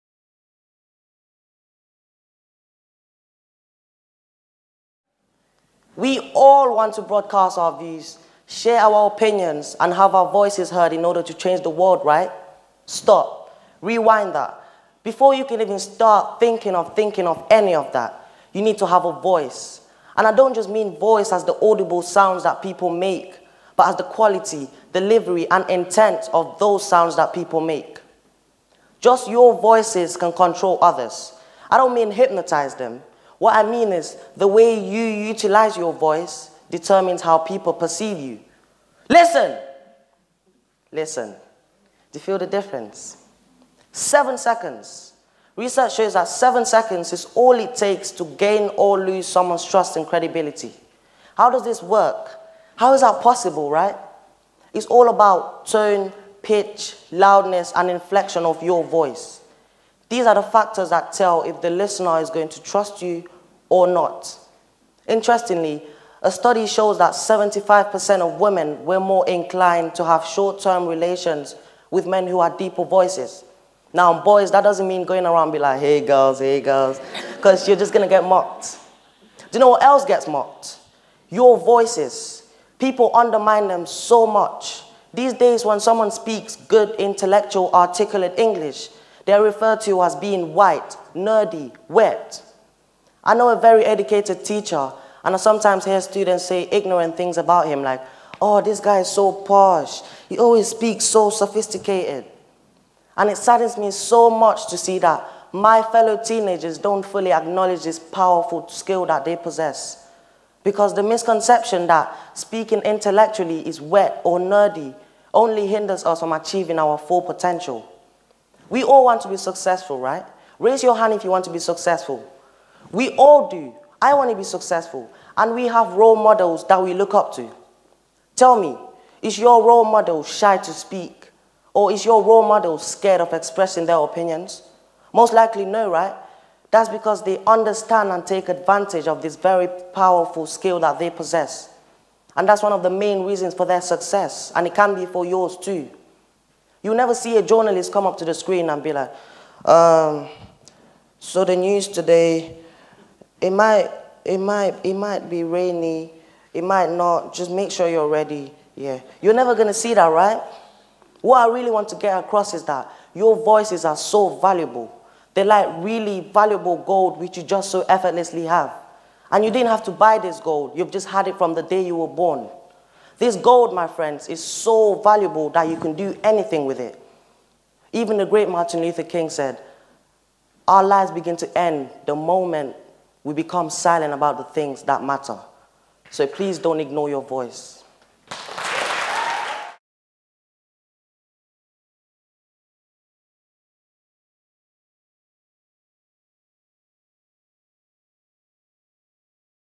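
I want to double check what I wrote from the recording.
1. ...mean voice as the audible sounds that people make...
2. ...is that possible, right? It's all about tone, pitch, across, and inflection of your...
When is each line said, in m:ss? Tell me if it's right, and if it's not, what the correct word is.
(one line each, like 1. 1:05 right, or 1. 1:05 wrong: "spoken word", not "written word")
1. 0:20 right
2. 0:52 wrong: "loudness", not "across".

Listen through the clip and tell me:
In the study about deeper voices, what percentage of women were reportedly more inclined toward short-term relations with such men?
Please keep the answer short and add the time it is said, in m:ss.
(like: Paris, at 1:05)
75%, at 1:07.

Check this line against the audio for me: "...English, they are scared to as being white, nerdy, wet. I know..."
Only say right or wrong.
wrong.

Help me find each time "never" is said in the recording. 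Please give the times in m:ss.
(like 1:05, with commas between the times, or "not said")
2:26, 2:39.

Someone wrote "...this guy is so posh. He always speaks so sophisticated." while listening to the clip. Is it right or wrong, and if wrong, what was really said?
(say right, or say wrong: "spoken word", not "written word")
right.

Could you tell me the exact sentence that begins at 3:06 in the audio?
So please don't ignore your voice.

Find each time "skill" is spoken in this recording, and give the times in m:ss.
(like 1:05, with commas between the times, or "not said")
1:48, 2:20.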